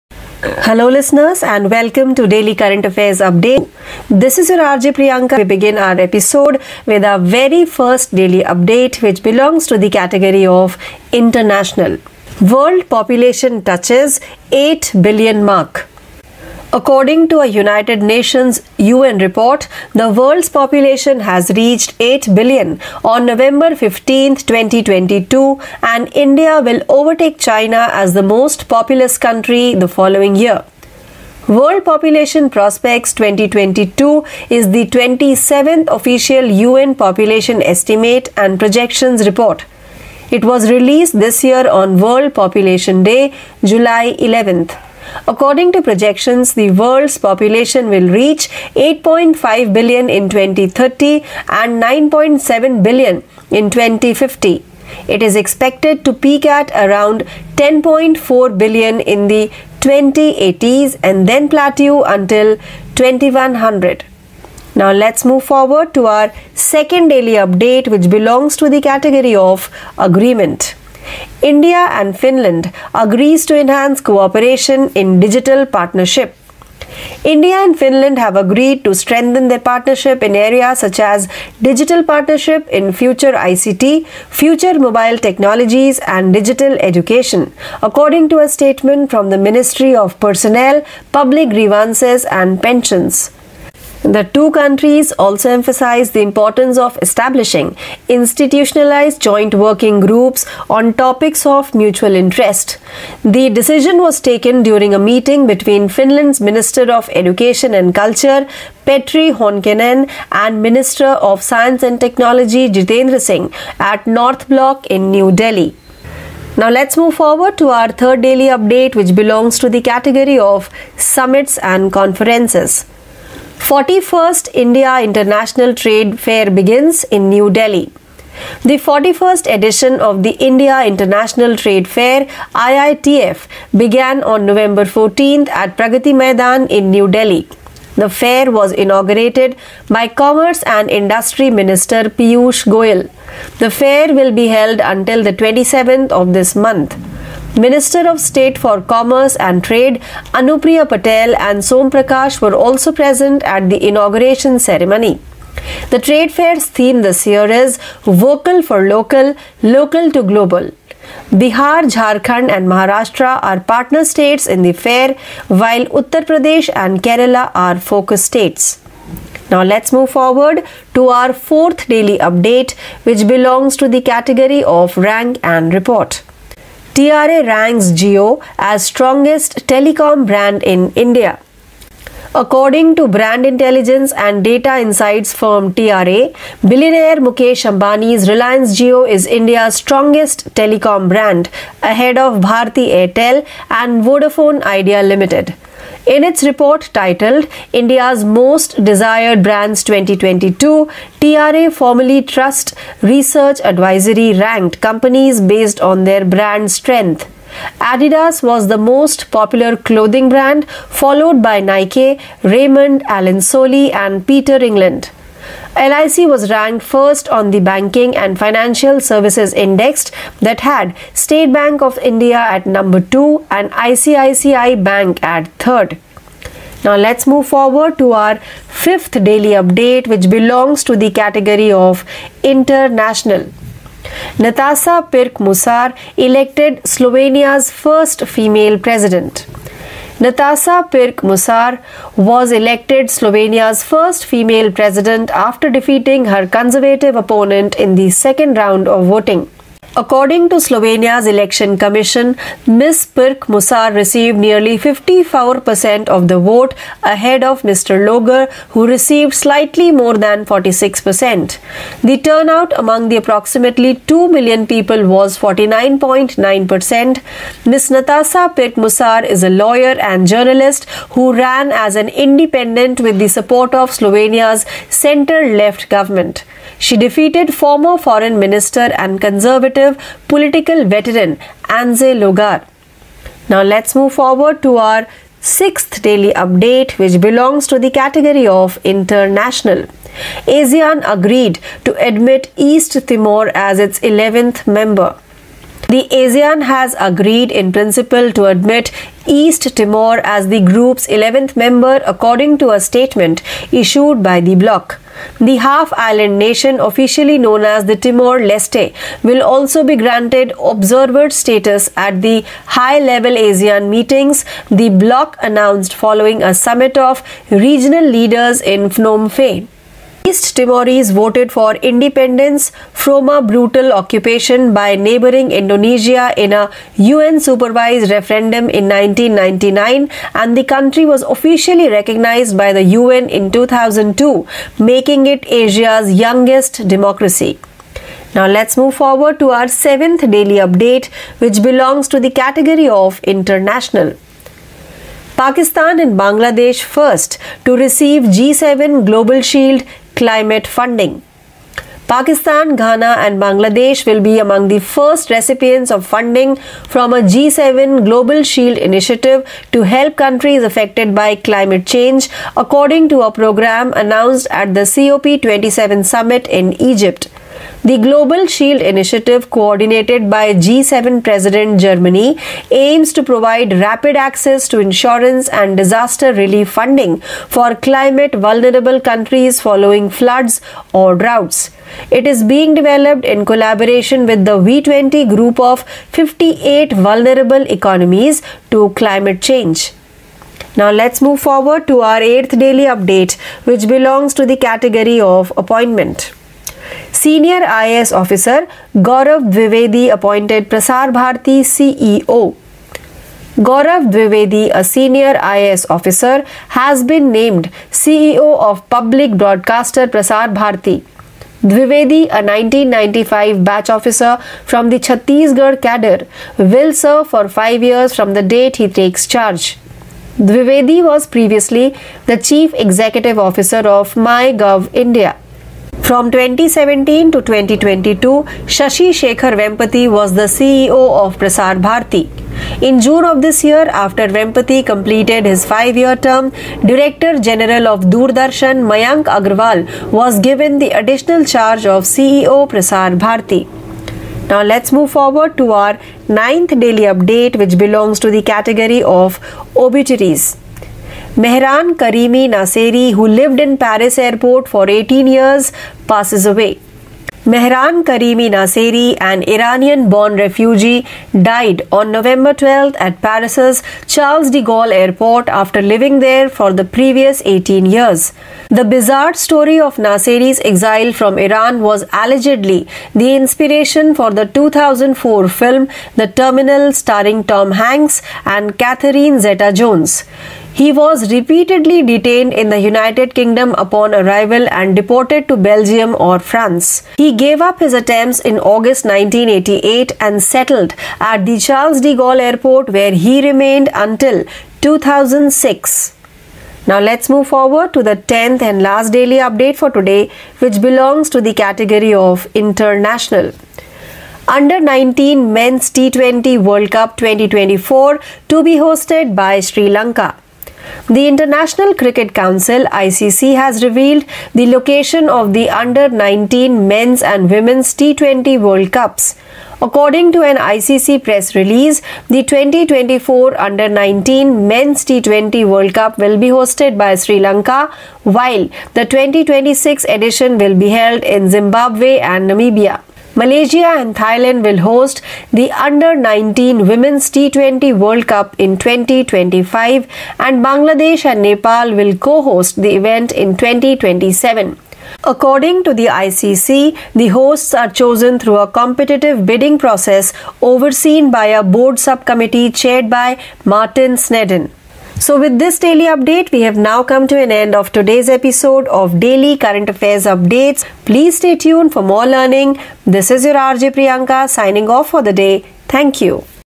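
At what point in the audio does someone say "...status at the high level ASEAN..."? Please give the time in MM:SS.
05:11.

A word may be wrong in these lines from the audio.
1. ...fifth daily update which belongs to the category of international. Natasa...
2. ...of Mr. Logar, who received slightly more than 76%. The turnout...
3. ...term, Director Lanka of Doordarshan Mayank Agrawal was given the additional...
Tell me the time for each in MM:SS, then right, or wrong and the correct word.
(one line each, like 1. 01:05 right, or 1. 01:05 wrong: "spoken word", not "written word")
1. 03:48 right
2. 04:17 wrong: "46", not "76"
3. 07:16 wrong: "General", not "Lanka".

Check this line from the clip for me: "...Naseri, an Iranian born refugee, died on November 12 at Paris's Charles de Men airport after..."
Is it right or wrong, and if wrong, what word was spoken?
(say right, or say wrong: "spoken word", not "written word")
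wrong: "Gaulle", not "Men".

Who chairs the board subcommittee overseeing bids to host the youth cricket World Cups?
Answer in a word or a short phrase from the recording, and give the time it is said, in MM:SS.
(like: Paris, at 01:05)
Martin Snedden, at 09:13.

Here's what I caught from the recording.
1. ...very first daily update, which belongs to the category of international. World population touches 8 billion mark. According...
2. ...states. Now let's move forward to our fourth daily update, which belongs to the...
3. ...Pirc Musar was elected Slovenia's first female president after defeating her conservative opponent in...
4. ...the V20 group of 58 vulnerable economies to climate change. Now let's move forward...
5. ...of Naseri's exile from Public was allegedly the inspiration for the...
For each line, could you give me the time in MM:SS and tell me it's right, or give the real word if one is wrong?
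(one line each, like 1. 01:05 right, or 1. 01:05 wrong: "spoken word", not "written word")
1. 00:07 right
2. 02:48 right
3. 04:00 right
4. 06:24 right
5. 07:49 wrong: "Iran", not "Public".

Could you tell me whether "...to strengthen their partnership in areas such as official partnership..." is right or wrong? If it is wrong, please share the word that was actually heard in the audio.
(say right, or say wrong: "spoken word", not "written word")
wrong: "digital", not "official".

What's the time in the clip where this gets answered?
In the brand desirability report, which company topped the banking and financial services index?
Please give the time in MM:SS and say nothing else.
03:35.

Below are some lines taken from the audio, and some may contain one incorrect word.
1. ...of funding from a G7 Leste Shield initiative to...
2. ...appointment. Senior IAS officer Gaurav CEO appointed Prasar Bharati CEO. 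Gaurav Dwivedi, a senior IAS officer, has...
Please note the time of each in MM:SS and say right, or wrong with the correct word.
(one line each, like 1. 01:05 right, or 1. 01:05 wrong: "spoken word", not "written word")
1. 05:55 wrong: "Global", not "Leste"
2. 06:35 wrong: "Dwivedi", not "CEO".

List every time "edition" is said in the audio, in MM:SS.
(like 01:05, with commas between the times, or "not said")
02:09, 08:50.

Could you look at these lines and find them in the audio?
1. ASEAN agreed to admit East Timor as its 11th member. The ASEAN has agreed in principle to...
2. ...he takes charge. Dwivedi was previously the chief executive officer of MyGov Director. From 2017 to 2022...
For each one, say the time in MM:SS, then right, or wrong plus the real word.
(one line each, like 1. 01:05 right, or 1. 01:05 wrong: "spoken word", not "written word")
1. 04:50 right
2. 06:58 wrong: "India", not "Director".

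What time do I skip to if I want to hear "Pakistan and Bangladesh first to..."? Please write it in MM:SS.
05:45.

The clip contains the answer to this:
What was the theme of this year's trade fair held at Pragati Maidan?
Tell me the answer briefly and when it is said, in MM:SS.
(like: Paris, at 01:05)
Vocal for Local, Local to Global, at 02:38.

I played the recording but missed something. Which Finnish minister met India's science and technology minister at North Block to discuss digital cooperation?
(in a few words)
Petri Honkonen.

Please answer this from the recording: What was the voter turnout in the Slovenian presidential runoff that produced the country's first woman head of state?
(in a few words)
49.9%.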